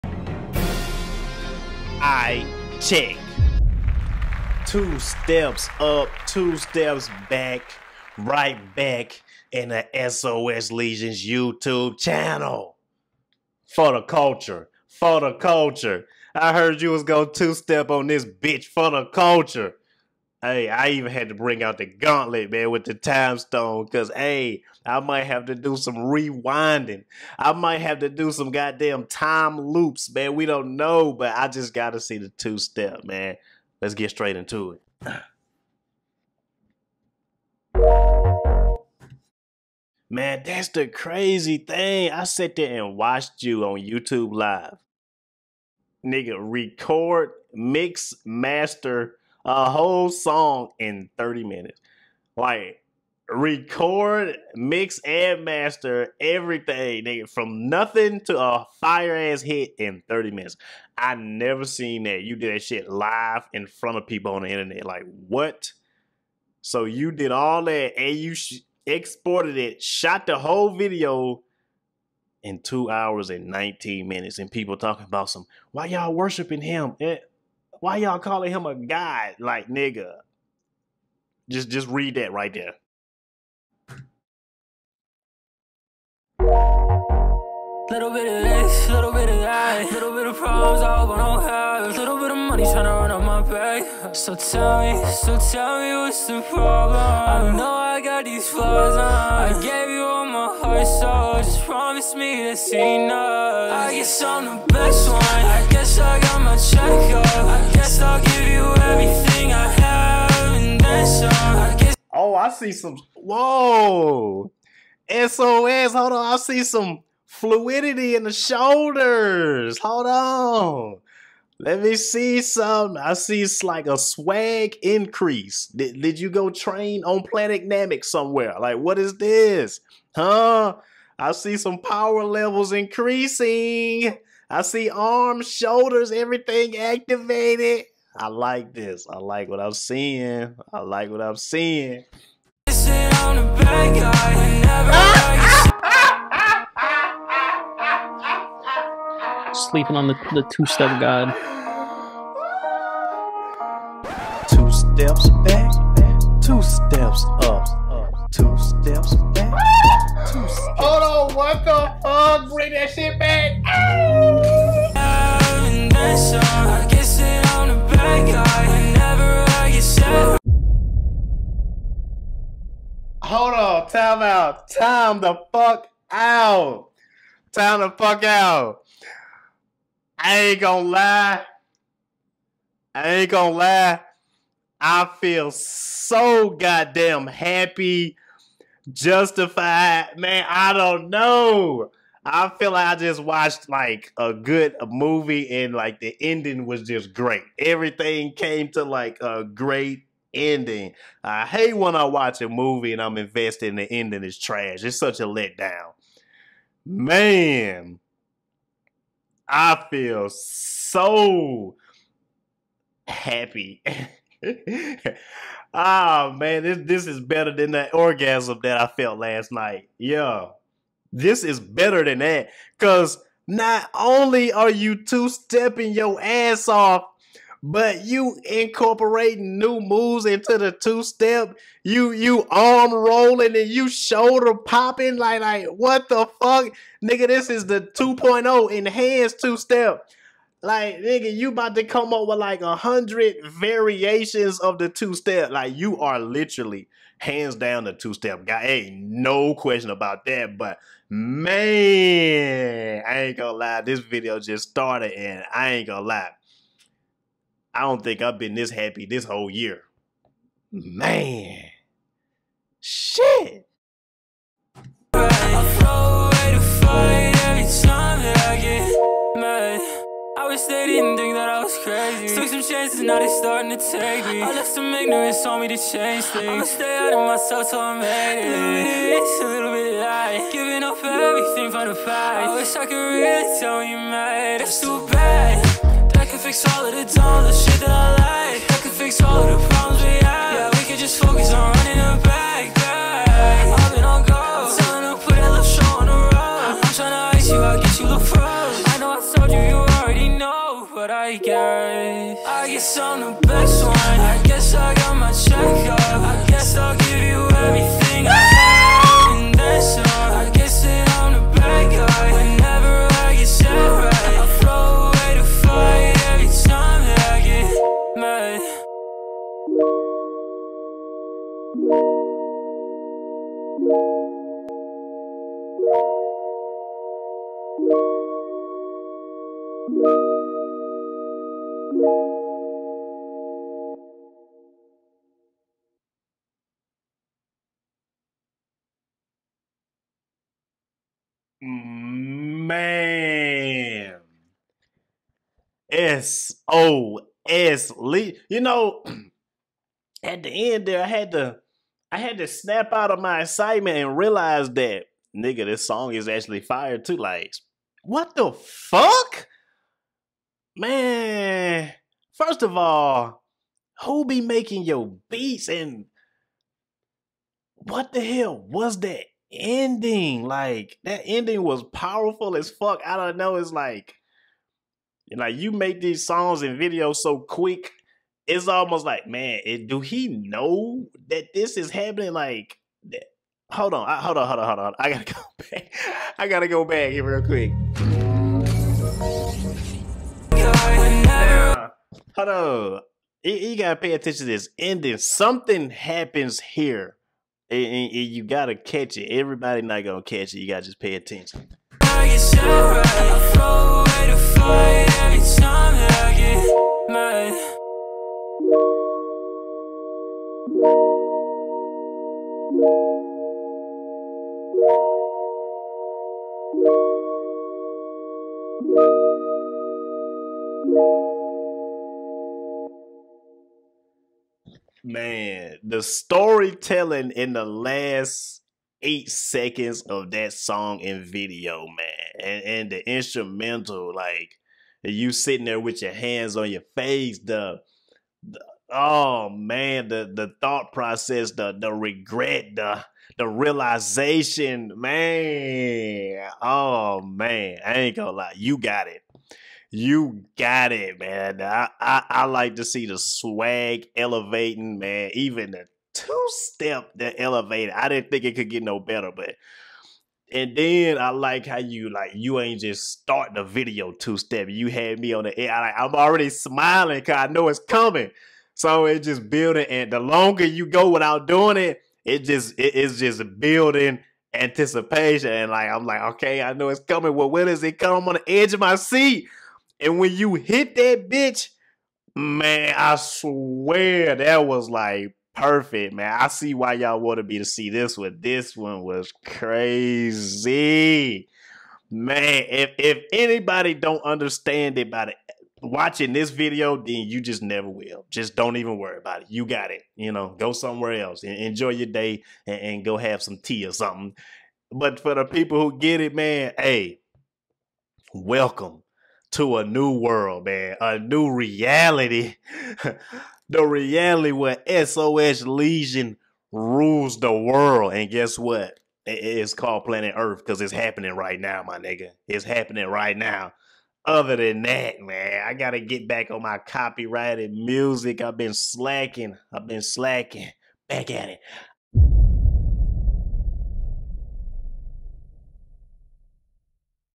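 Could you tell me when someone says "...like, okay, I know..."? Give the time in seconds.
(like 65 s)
476 s.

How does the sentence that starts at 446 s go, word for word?
Oh man, I ain't gonna lie, you got it.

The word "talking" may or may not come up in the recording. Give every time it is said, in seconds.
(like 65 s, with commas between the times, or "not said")
74 s.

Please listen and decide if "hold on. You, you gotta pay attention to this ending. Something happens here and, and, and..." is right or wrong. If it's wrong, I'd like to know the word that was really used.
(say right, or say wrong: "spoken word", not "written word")
right.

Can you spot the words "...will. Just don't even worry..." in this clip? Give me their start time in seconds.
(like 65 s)
497 s.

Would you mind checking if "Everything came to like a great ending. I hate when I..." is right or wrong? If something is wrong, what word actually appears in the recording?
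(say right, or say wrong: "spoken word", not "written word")
right.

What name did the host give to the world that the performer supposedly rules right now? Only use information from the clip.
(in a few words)
Planet Earth.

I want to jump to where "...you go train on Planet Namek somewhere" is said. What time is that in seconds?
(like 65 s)
126 s.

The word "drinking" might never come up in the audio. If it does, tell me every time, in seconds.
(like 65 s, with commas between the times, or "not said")
not said.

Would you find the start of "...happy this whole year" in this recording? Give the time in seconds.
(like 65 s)
258 s.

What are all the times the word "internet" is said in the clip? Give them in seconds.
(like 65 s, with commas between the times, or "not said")
64 s.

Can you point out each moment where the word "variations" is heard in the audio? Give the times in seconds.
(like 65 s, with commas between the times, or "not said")
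243 s.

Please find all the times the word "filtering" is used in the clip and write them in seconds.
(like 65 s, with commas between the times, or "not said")
not said.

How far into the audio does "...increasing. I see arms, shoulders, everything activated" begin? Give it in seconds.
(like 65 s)
132 s.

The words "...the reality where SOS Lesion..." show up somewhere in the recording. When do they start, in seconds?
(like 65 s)
513 s.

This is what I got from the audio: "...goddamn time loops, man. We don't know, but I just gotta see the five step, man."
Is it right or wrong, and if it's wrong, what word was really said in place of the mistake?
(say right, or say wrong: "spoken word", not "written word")
wrong: "two", not "five".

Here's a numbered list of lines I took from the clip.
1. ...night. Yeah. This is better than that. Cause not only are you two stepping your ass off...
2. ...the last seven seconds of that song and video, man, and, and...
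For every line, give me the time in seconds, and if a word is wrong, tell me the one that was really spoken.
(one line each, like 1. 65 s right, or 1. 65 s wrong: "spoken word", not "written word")
1. 219 s right
2. 427 s wrong: "eight", not "seven".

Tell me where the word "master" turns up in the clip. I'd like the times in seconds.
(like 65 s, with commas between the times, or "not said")
48 s, 55 s.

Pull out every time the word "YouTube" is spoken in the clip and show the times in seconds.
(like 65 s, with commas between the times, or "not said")
11 s, 43 s.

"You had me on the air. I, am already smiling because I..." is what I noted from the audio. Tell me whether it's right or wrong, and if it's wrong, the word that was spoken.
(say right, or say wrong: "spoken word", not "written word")
right.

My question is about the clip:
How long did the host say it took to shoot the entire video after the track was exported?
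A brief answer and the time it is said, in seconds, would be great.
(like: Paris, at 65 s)
2 hours and 19 minutes, at 72 s.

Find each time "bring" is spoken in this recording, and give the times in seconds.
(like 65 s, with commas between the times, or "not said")
21 s, 162 s.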